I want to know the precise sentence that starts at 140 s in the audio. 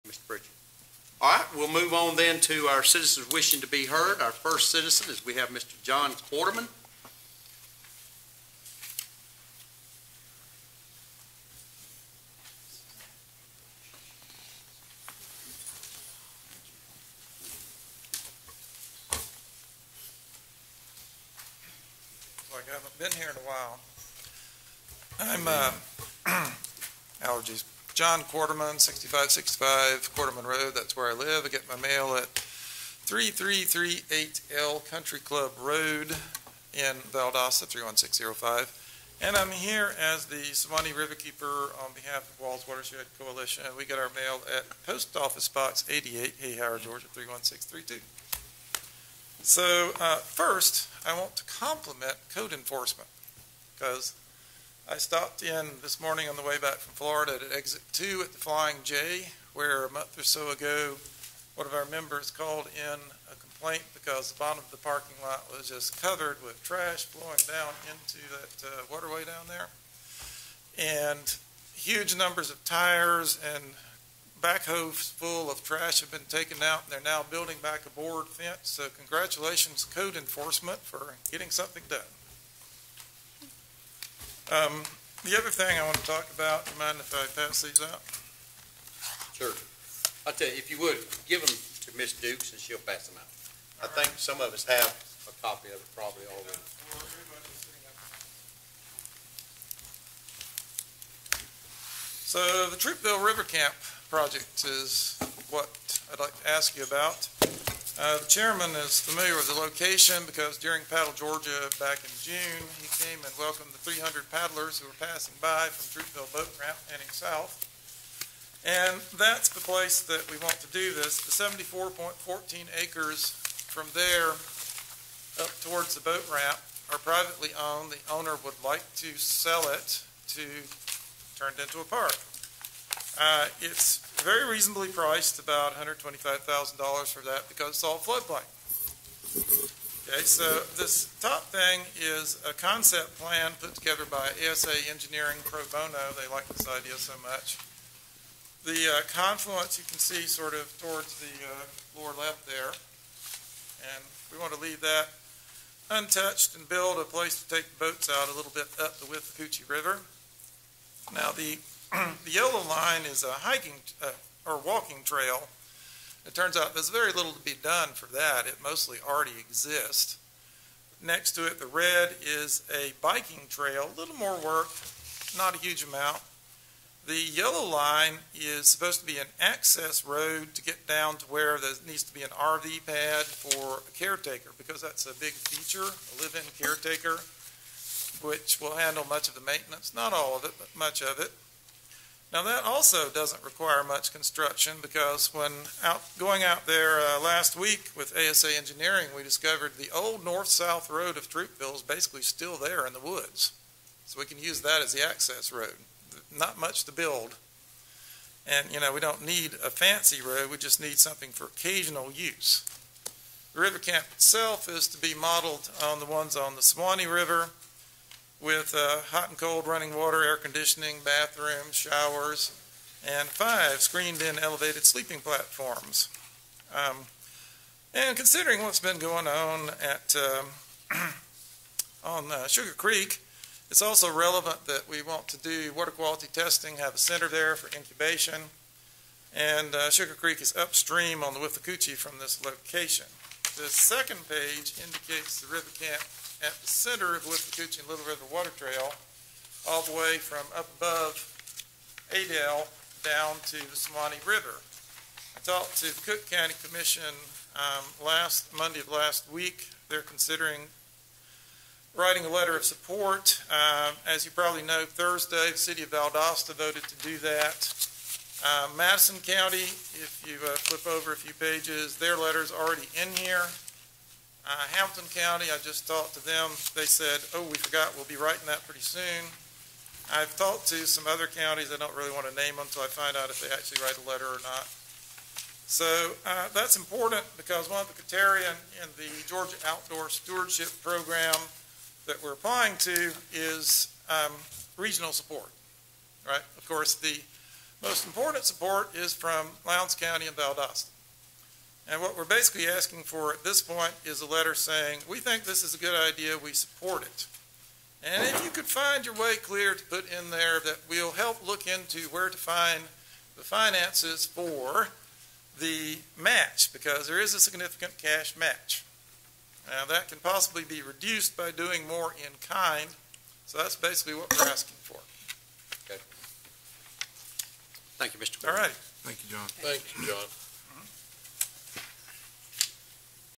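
Okay, so this top thing is a concept plan put together by ASA Engineering Pro Bono.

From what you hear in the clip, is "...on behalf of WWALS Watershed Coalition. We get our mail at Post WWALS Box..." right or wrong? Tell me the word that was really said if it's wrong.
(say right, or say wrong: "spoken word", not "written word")
wrong: "Office", not "WWALS".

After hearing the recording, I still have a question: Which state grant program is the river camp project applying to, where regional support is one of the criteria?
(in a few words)
Georgia Outdoor Stewardship Program.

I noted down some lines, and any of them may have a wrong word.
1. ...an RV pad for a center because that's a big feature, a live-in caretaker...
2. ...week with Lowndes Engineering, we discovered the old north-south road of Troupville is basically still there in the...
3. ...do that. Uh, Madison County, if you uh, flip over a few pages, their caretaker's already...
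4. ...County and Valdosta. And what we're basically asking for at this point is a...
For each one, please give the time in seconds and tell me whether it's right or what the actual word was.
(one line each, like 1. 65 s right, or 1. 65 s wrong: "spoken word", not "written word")
1. 182 s wrong: "caretaker", not "center"
2. 197 s wrong: "ASA", not "Lowndes"
3. 267 s wrong: "letter", not "caretaker"
4. 299 s right.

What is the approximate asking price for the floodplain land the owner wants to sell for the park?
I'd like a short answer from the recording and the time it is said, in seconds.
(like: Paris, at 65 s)
$125,000, at 135 s.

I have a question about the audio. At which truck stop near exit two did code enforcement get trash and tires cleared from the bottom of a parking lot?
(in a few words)
Flying J.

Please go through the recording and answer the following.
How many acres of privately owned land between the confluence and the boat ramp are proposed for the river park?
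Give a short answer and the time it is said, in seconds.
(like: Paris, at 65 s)
74.14, at 121 s.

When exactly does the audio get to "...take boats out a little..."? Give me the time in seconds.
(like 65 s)
157 s.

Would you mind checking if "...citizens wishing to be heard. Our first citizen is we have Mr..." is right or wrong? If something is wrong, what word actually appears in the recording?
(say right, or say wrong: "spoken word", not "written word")
right.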